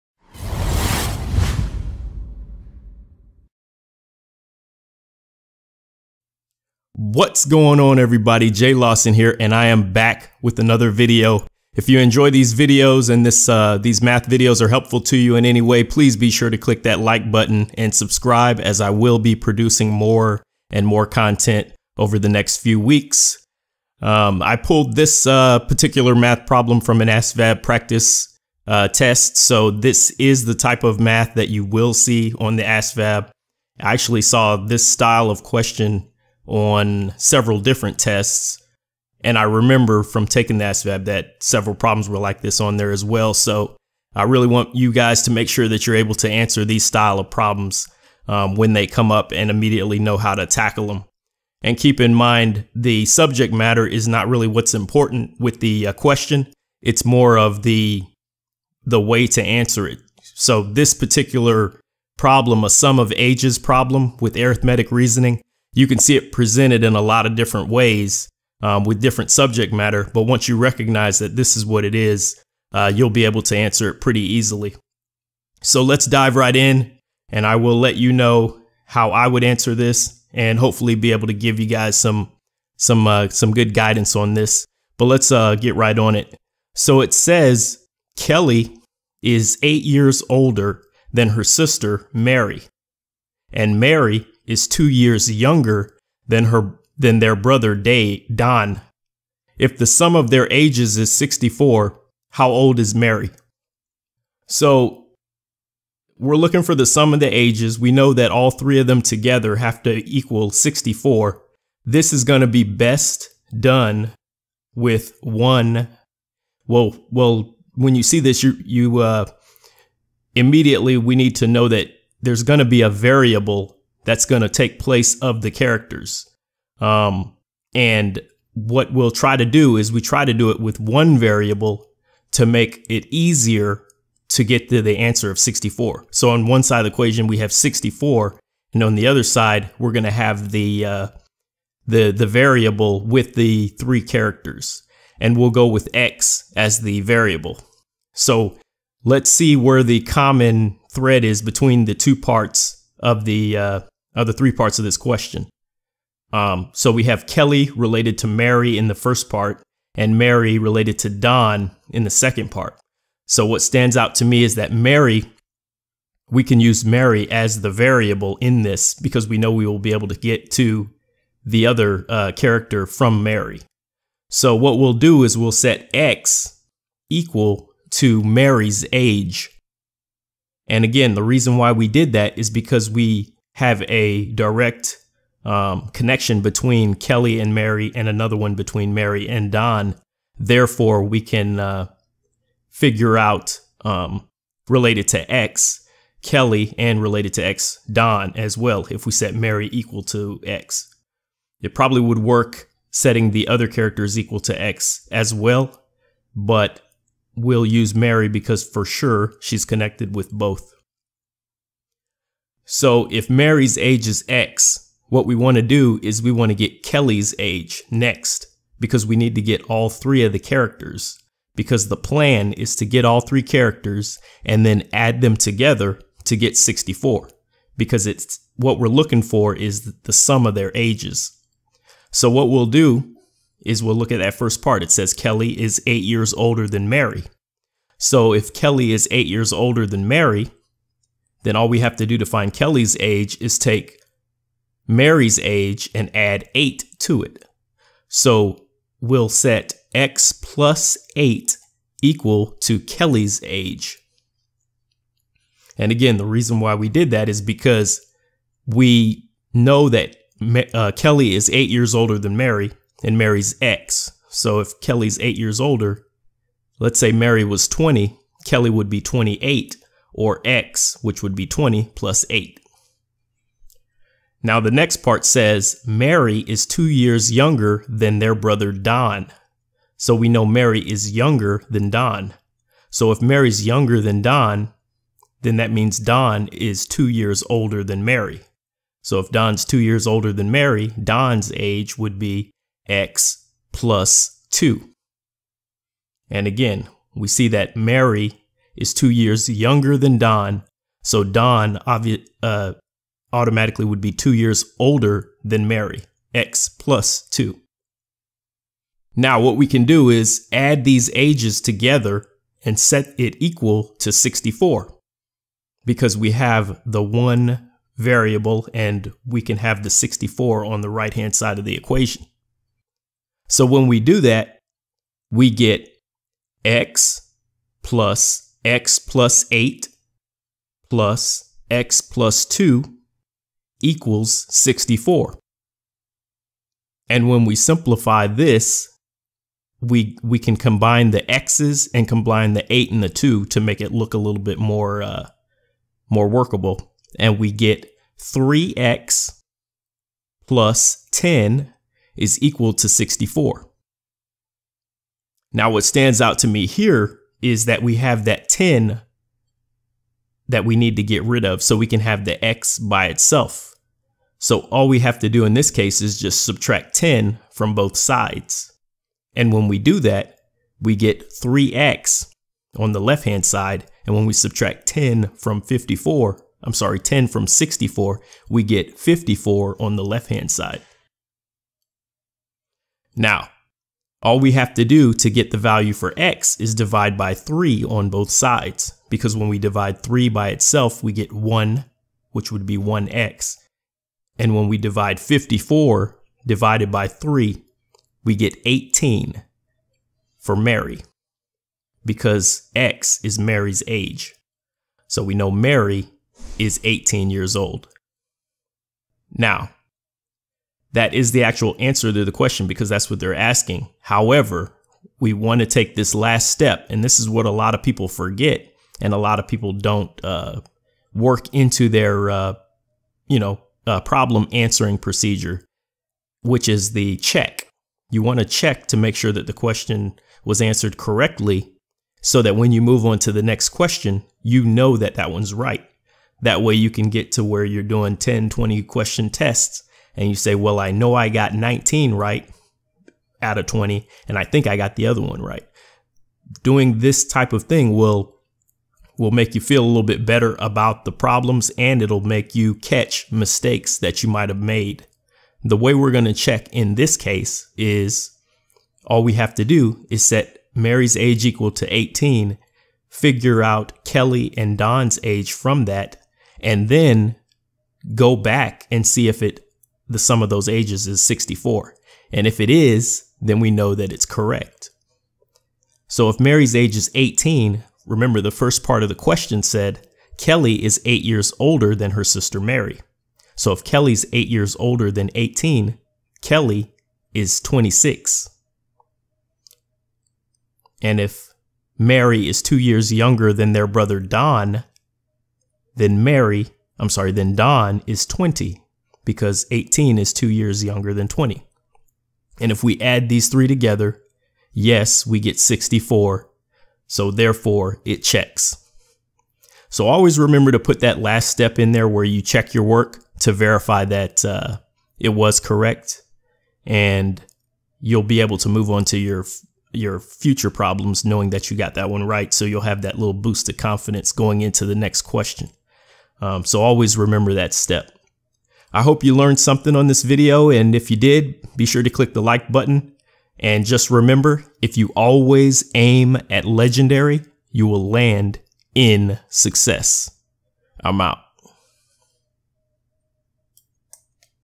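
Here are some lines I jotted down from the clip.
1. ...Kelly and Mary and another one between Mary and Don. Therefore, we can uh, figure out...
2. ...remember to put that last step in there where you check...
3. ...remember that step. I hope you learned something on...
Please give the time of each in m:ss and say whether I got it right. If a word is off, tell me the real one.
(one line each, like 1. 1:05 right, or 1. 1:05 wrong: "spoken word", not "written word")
1. 3:06 right
2. 8:30 right
3. 8:47 right.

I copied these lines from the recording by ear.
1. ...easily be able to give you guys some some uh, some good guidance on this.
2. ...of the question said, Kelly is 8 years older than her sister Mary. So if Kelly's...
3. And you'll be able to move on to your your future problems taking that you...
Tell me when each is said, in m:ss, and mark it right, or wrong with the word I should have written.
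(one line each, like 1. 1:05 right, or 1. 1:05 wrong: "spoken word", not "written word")
1. 1:20 wrong: "hopefully", not "easily"
2. 7:59 right
3. 8:36 wrong: "knowing", not "taking".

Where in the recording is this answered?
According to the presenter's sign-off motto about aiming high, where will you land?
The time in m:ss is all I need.
8:59.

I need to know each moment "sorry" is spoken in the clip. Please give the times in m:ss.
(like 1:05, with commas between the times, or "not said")
6:16, 8:17.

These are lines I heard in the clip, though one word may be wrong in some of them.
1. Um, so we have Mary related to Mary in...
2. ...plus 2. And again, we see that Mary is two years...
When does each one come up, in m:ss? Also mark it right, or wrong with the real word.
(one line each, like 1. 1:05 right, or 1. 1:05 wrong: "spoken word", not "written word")
1. 2:36 wrong: "Kelly", not "Mary"
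2. 4:53 right.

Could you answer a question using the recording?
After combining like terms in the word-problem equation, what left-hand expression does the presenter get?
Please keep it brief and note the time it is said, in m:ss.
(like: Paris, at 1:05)
3x + 10, at 5:48.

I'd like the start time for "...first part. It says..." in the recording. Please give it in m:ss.
3:54.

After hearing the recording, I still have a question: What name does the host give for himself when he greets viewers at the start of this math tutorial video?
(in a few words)
Jay Lawson.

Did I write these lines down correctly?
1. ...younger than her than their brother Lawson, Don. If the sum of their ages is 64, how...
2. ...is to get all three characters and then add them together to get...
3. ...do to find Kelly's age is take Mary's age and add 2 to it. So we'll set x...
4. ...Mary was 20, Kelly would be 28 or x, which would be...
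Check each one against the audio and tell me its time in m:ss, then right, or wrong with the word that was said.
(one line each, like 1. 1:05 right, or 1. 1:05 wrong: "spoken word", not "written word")
1. 1:35 wrong: "Day", not "Lawson"
2. 3:42 right
3. 4:02 wrong: "8", not "2"
4. 4:27 right.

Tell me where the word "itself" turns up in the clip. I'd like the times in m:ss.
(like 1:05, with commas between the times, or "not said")
6:03, 6:30.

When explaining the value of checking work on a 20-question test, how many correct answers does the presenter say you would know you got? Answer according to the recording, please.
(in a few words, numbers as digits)
19.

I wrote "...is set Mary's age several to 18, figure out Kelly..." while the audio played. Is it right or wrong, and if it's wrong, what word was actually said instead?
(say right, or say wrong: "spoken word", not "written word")
wrong: "equal", not "several".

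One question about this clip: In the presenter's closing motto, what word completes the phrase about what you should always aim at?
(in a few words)
legendary.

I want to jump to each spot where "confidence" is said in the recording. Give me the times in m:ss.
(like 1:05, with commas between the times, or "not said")
8:43.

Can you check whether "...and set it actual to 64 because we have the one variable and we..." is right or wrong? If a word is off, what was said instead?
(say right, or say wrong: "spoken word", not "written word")
wrong: "equal", not "actual".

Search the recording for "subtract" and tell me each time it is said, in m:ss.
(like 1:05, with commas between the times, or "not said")
6:06, 6:14.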